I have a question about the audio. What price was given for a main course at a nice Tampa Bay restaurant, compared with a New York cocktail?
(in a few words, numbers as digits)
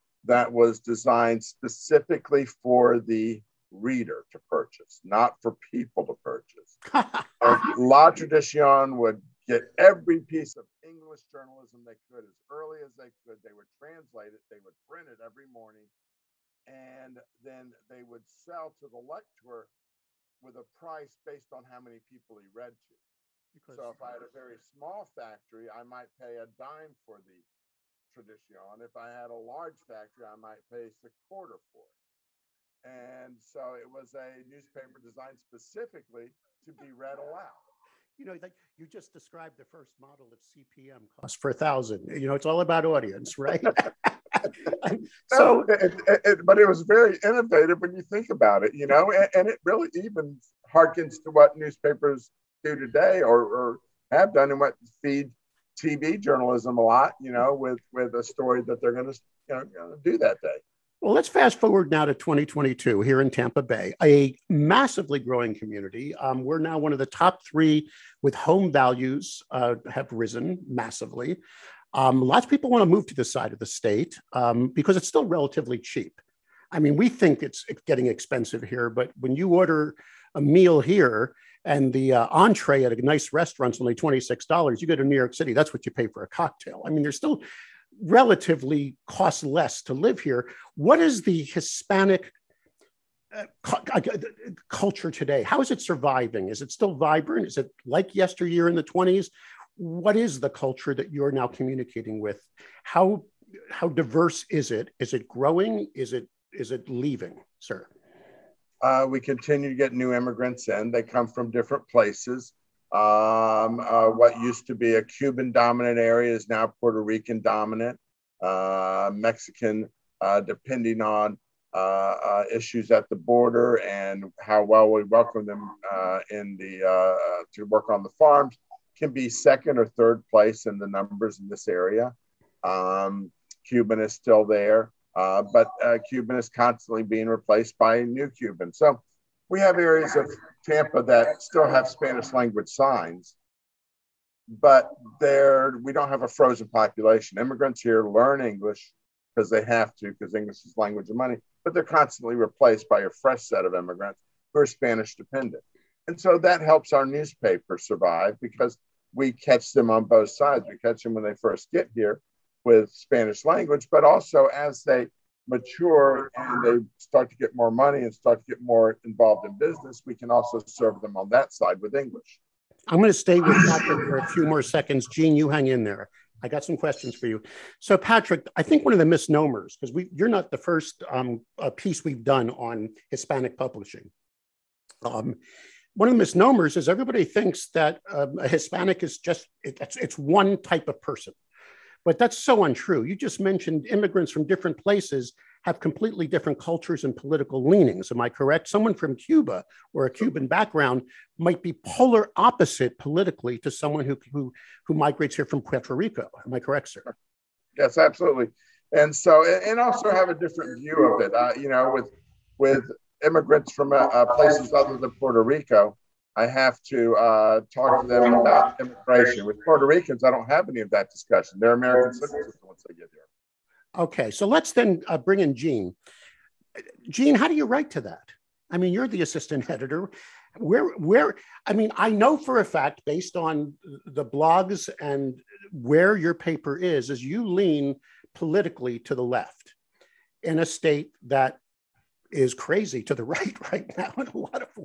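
$26.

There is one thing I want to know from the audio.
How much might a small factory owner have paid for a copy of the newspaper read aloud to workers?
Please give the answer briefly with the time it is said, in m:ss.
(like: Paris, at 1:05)
a dime, at 0:26.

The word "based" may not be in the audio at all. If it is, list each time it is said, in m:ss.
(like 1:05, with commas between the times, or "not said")
0:21, 3:53.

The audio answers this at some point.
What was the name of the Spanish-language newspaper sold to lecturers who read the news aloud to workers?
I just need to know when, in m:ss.
0:07.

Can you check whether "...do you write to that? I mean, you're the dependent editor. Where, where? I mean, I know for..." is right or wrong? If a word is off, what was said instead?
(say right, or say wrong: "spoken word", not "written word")
wrong: "assistant", not "dependent".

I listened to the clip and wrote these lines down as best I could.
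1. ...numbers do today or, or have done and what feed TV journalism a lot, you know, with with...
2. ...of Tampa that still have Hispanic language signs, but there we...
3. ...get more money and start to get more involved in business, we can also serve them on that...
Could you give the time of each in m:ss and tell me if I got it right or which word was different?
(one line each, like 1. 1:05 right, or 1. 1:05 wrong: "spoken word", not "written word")
1. 0:51 wrong: "newspapers", not "numbers"
2. 2:20 wrong: "Spanish", not "Hispanic"
3. 2:47 right.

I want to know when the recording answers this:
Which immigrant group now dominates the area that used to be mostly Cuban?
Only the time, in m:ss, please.
1:56.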